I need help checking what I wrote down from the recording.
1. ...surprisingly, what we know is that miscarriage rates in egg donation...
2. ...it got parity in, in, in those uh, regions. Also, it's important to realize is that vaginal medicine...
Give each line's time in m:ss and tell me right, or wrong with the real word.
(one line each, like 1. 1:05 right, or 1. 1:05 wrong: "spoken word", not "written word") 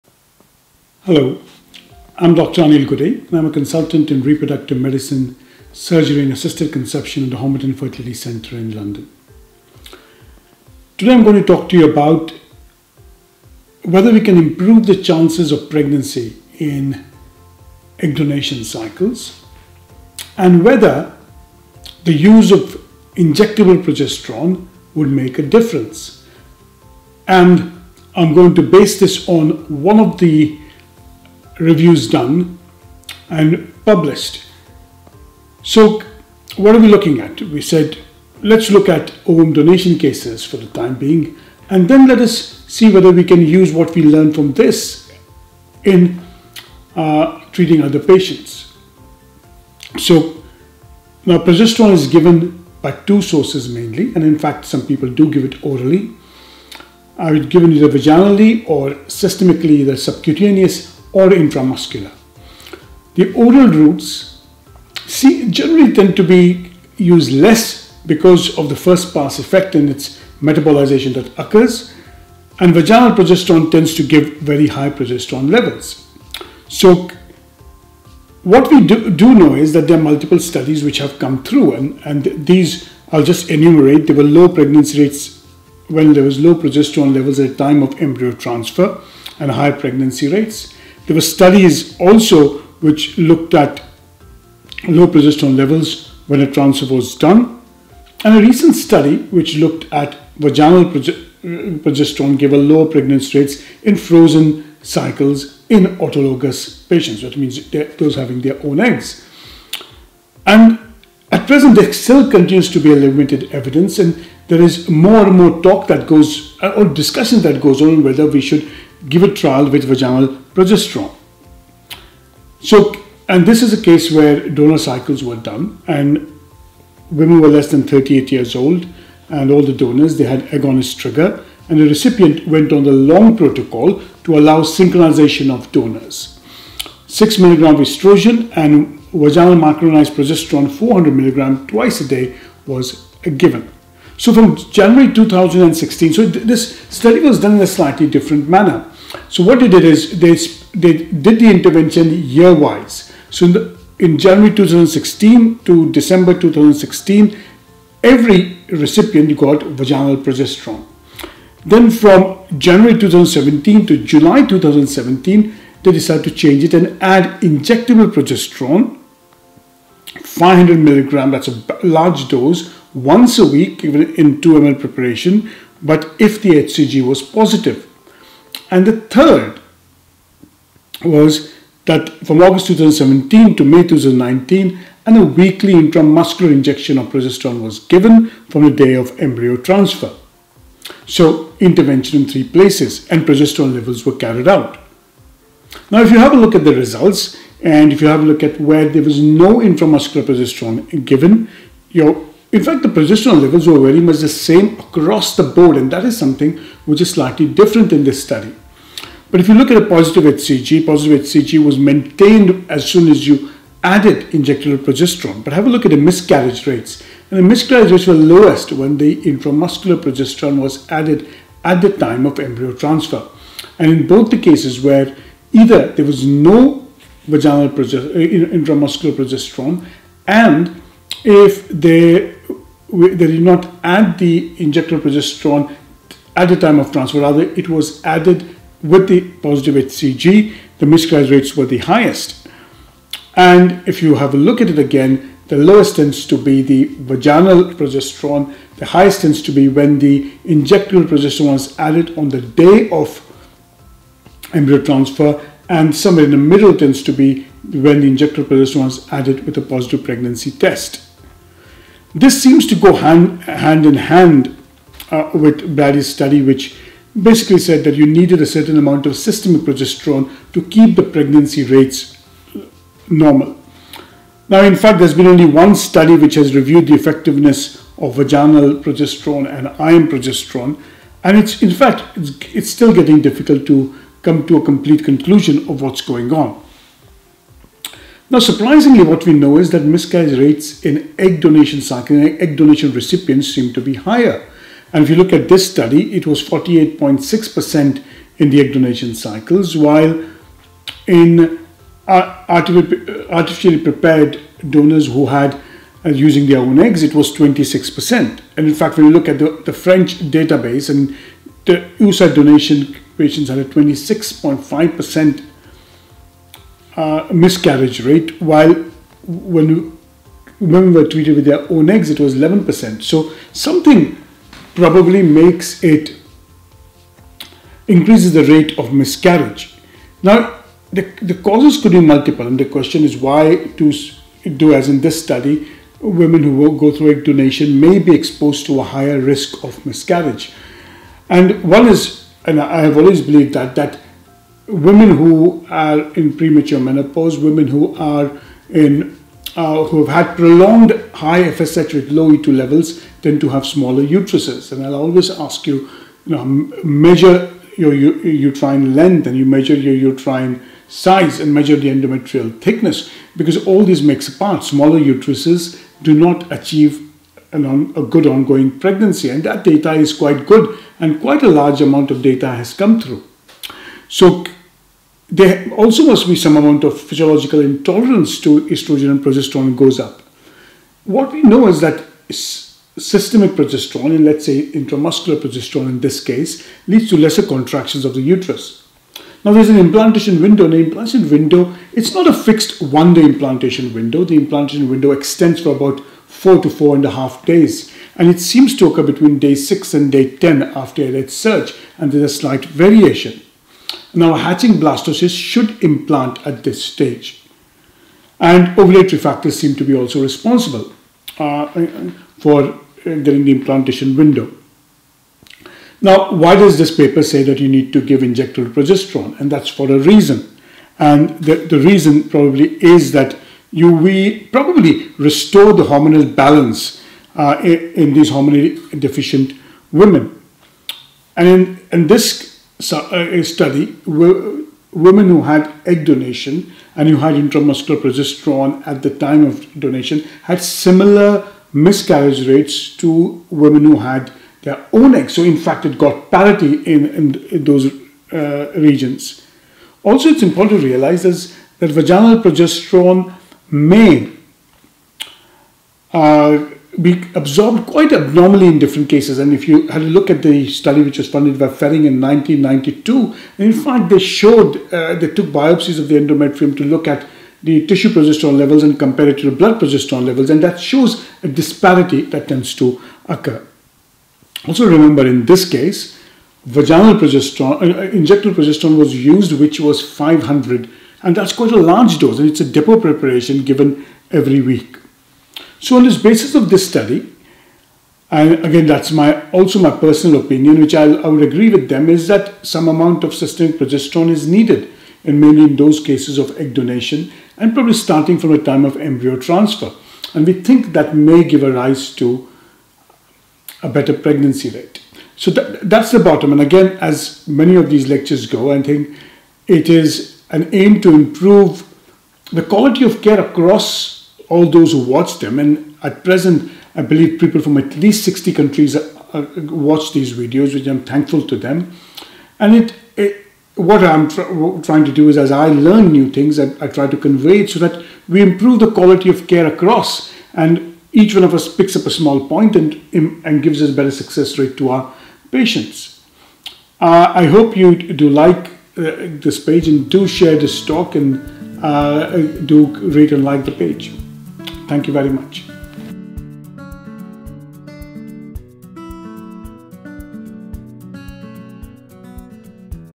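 1. 4:48 right
2. 7:25 wrong: "progesterone", not "medicine".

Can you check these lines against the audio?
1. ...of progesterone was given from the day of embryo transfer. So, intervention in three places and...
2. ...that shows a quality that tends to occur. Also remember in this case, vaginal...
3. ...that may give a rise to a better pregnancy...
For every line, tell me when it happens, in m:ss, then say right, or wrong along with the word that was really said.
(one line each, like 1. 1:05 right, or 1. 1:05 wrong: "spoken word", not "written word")
1. 3:06 right
2. 7:50 wrong: "disparity", not "quality"
3. 8:20 right.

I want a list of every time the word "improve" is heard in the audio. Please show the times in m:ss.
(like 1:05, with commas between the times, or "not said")
0:14, 8:31, 8:48.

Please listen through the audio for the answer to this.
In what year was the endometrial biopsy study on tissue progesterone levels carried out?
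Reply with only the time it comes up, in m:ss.
7:42.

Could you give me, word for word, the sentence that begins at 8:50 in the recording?
And each one of us picks up a small point and, and gives us better success rate to our patients.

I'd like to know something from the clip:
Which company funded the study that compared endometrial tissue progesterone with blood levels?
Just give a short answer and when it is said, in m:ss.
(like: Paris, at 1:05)
Ferring, at 7:41.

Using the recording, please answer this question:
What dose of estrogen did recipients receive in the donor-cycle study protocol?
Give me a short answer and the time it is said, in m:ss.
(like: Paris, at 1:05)
6 milligram, at 2:17.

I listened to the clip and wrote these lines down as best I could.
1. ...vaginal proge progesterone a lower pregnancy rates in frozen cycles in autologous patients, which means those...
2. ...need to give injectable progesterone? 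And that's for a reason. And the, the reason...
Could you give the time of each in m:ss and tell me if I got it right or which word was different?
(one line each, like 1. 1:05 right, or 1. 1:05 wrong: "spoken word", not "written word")
1. 1:40 right
2. 6:57 right.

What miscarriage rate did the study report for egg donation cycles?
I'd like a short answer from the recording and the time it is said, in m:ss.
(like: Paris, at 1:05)
48.6%, at 4:56.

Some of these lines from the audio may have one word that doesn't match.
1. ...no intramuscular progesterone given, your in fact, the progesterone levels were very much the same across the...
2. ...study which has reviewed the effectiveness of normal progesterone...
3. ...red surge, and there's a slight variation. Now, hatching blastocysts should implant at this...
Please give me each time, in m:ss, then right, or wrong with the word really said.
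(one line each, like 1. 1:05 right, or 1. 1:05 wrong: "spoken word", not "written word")
1. 3:19 right
2. 4:35 wrong: "vaginal", not "normal"
3. 6:41 right.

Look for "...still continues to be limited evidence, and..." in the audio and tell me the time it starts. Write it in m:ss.
1:51.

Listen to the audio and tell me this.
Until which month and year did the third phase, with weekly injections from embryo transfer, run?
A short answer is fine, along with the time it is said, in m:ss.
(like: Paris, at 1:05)
May 2019, at 3:03.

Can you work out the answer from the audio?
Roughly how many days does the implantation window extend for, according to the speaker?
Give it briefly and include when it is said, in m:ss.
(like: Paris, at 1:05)
4 to 4.5 days, at 6:36.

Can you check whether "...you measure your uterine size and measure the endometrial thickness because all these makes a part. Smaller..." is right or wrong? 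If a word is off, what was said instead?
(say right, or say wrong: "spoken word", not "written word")
right.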